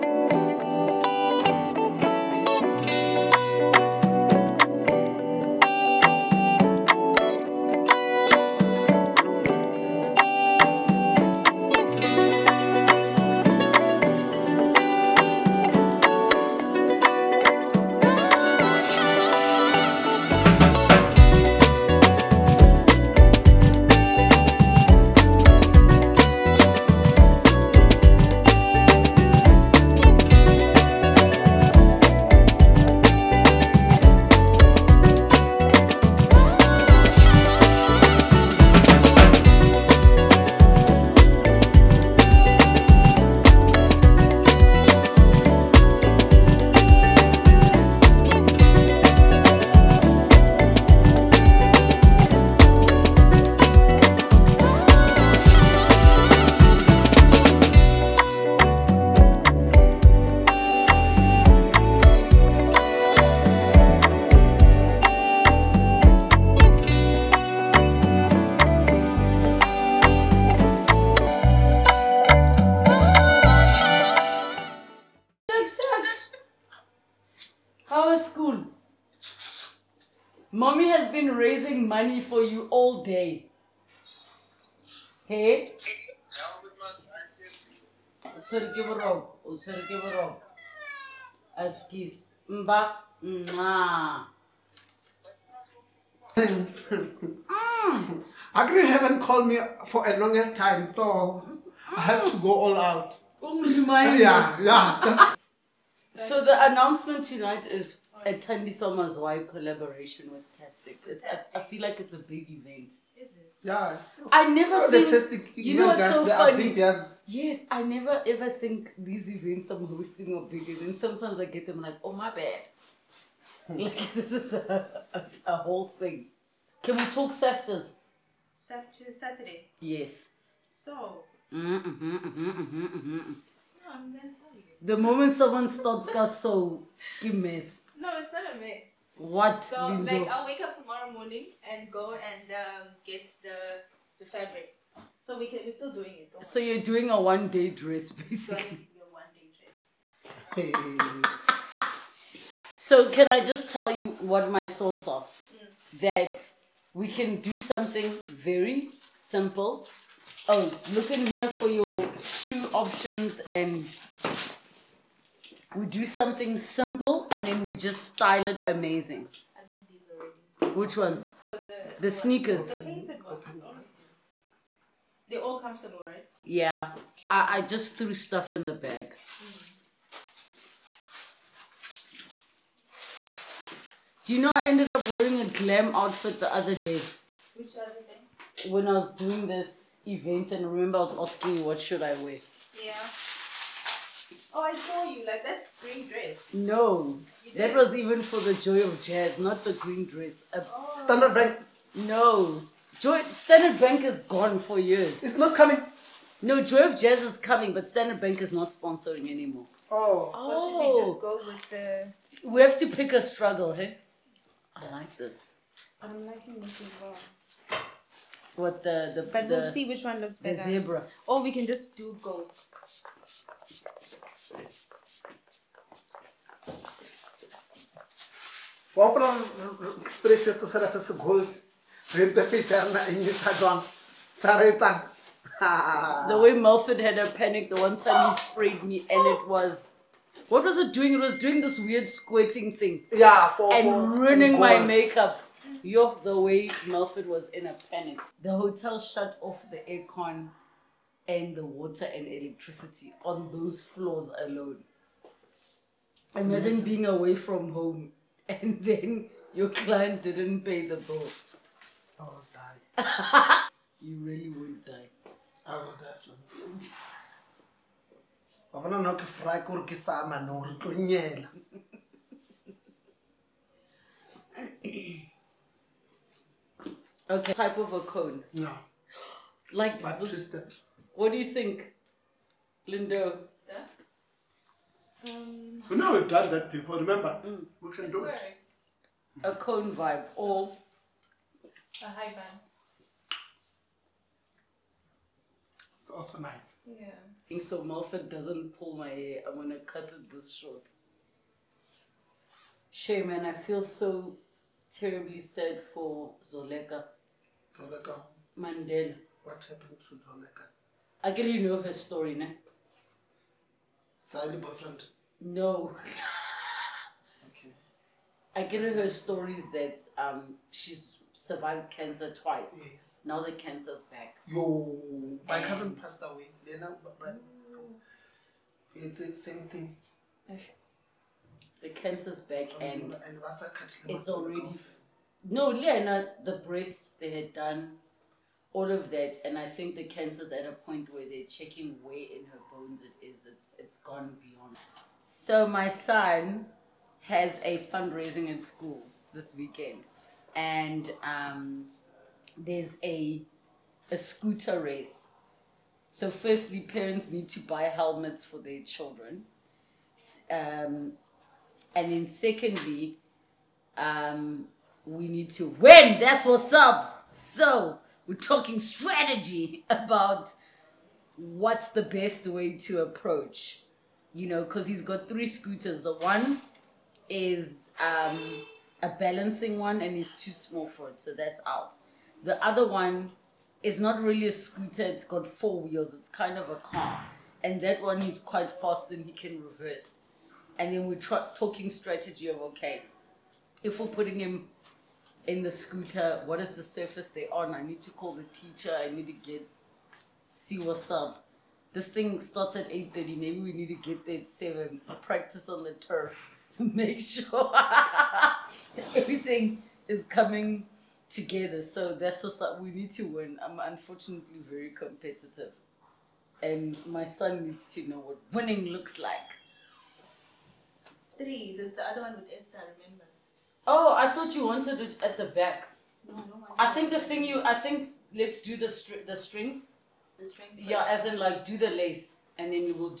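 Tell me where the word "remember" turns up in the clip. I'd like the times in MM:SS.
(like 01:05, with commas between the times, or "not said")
03:10, 04:46, 07:03.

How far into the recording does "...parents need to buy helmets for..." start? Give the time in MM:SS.
05:56.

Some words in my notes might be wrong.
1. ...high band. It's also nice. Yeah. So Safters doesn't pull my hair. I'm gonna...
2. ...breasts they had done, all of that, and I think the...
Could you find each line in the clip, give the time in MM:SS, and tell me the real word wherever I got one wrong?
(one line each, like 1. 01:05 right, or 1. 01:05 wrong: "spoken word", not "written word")
1. 04:52 wrong: "Malfit", not "Safters"
2. 05:36 right.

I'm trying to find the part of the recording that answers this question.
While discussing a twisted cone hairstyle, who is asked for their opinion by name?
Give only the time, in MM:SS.
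04:42.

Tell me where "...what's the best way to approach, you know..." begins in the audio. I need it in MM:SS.
06:11.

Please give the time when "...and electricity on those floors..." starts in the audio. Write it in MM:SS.
04:12.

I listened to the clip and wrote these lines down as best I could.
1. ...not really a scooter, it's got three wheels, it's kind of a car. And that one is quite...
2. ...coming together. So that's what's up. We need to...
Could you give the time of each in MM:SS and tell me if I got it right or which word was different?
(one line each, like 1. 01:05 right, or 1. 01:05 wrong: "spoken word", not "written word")
1. 06:23 wrong: "four", not "three"
2. 06:50 right.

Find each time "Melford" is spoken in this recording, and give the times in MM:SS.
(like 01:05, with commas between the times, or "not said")
03:56, 04:06.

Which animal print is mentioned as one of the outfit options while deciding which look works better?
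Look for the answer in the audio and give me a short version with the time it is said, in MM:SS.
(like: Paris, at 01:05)
Zebra, at 03:40.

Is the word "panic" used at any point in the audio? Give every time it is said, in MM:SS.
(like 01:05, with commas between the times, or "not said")
03:57, 04:07.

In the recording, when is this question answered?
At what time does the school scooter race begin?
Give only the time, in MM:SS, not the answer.
06:42.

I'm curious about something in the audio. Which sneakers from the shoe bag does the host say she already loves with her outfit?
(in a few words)
The painted ones.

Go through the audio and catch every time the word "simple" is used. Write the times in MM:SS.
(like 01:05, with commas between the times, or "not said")
02:39, 02:46.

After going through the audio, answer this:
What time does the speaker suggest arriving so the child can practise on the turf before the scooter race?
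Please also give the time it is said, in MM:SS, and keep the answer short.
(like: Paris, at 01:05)
7, at 06:44.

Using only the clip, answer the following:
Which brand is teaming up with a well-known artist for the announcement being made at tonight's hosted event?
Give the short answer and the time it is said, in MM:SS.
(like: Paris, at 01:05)
Tastic, at 01:50.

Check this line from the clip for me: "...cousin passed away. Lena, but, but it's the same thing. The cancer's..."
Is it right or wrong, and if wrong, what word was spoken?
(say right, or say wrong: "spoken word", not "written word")
right.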